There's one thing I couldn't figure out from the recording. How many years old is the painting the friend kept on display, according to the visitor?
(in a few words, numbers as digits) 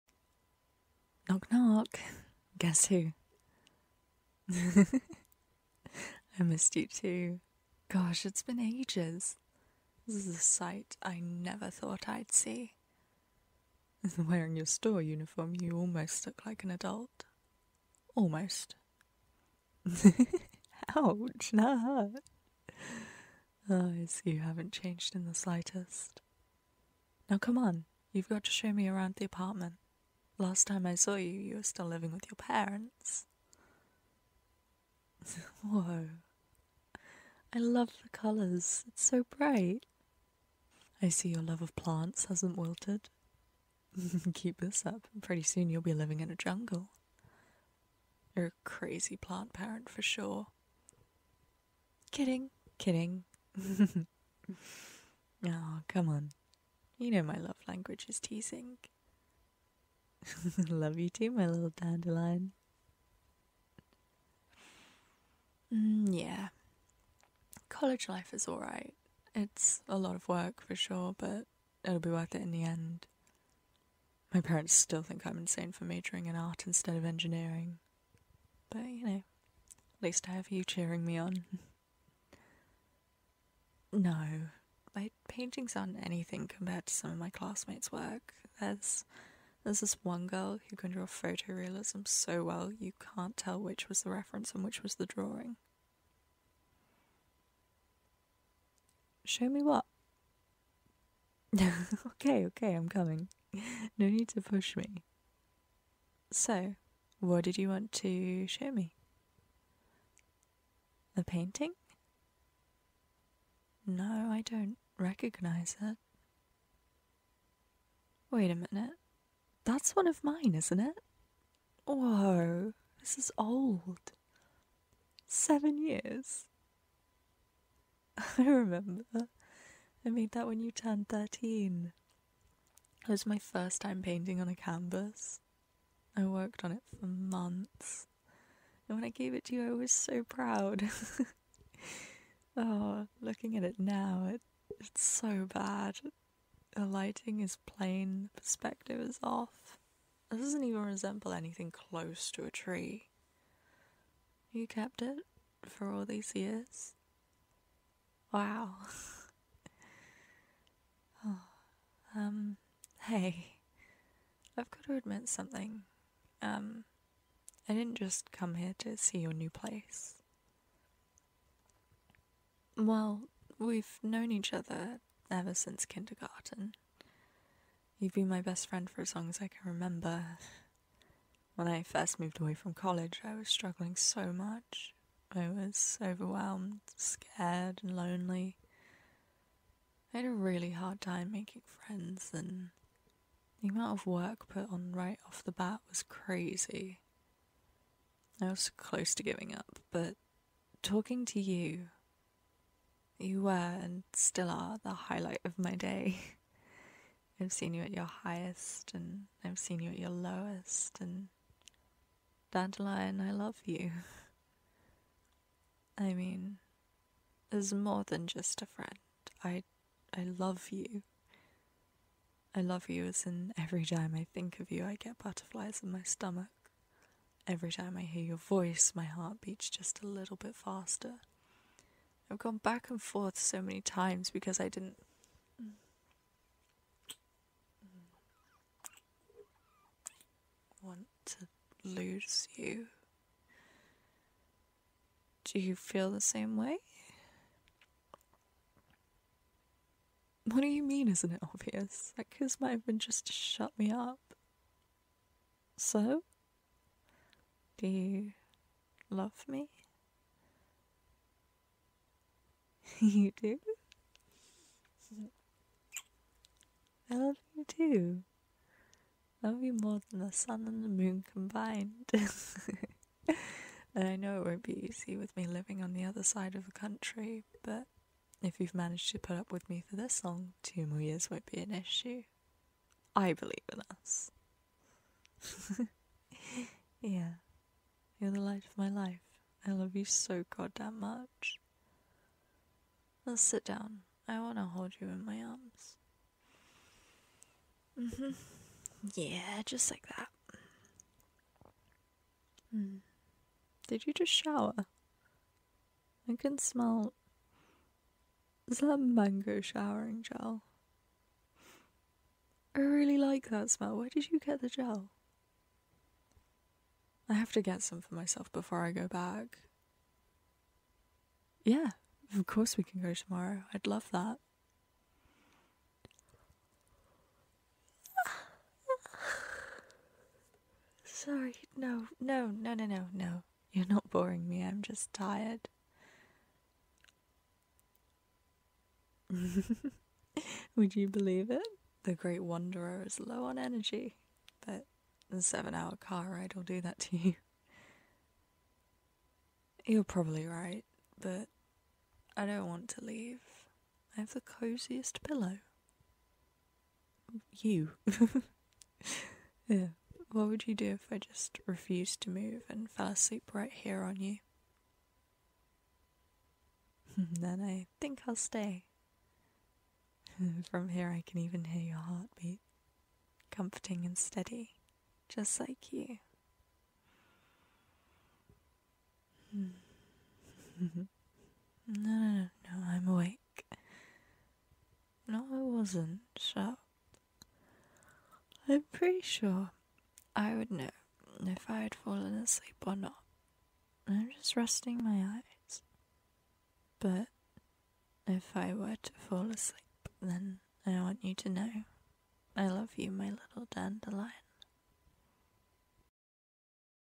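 7.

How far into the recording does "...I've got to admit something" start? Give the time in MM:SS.
02:44.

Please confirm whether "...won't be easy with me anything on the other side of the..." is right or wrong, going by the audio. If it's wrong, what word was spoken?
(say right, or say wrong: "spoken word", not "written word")
wrong: "living", not "anything".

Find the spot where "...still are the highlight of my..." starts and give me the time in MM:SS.
03:24.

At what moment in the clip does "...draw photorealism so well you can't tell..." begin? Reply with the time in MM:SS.
01:30.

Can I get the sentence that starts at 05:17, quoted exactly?
I have to get some for myself before I go back.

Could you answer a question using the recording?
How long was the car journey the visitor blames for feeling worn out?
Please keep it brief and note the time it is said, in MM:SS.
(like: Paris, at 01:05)
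7 hours, at 05:45.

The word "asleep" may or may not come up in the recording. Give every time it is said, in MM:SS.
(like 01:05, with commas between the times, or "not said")
06:03, 06:32, 06:39.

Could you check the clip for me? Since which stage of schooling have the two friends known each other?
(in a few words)
Kindergarten.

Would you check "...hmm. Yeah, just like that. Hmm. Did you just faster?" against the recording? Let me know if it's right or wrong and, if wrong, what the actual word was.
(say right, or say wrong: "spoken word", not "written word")
wrong: "shower", not "faster".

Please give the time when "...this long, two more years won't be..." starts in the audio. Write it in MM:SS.
04:39.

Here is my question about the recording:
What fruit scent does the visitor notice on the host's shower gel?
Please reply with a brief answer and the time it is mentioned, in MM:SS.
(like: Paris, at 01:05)
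Mango, at 05:08.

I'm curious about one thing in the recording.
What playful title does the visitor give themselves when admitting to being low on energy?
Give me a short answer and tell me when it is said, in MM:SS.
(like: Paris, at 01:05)
The Great Wanderer, at 05:42.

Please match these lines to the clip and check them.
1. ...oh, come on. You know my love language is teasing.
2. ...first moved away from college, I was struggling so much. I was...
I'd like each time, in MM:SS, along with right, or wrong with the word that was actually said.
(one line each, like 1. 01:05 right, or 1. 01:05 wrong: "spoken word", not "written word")
1. 00:55 right
2. 03:01 right.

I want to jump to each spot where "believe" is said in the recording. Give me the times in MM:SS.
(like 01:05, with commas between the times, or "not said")
04:43, 05:41.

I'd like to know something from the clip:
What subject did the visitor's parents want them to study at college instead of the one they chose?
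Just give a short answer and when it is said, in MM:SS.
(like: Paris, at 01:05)
Engineering, at 01:17.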